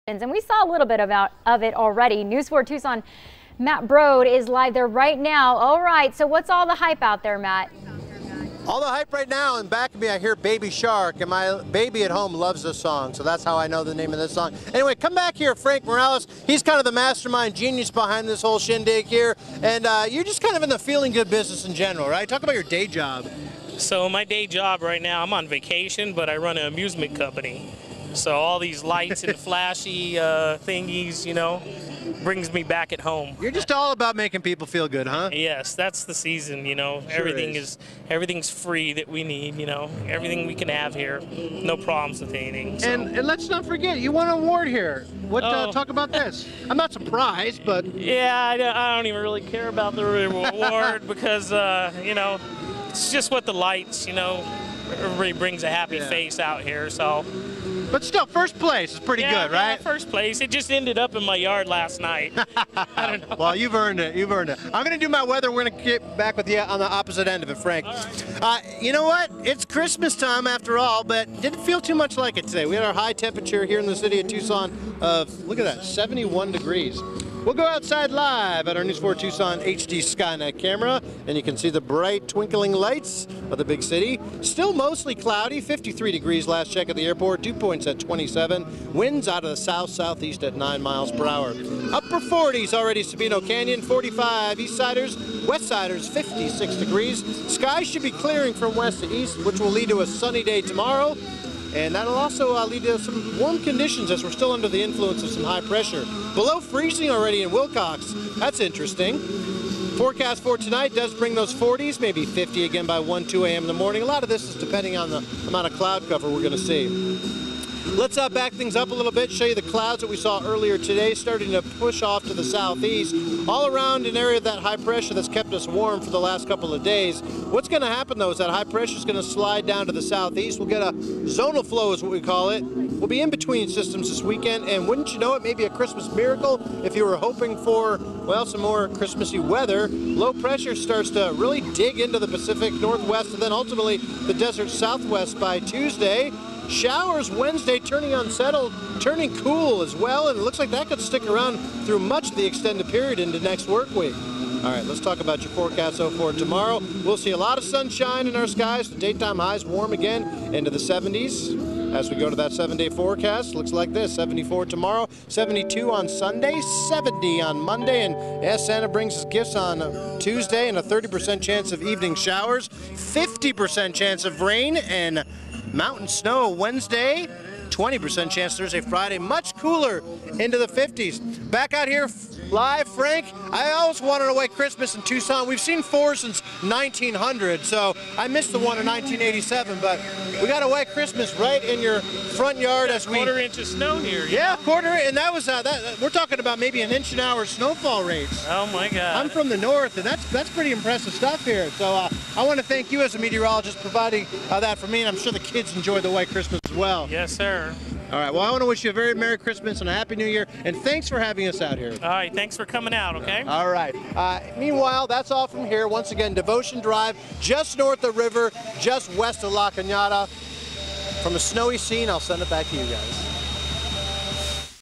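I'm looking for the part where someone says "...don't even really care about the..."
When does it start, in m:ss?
0:48.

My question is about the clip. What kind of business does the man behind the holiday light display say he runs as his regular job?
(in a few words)
An amusement company.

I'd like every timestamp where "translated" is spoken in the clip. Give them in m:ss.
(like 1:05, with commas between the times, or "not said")
not said.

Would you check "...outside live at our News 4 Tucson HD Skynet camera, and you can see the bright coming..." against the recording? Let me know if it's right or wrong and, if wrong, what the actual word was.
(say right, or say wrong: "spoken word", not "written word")
wrong: "twinkling", not "coming".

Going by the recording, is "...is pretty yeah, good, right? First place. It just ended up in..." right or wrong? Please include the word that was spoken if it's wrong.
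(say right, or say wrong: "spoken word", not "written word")
right.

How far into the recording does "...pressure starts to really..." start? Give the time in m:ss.
2:20.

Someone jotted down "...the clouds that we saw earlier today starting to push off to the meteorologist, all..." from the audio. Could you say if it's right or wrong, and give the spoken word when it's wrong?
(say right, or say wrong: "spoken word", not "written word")
wrong: "southeast", not "meteorologist".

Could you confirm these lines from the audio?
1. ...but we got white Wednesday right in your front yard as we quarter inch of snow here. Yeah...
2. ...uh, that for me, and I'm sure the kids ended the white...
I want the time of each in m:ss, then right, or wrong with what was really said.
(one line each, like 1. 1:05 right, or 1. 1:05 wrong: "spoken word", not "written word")
1. 3:09 wrong: "Christmas", not "Wednesday"
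2. 3:24 wrong: "enjoyed", not "ended".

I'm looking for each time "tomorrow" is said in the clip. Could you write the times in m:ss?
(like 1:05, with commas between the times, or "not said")
1:40, 2:36, 2:44.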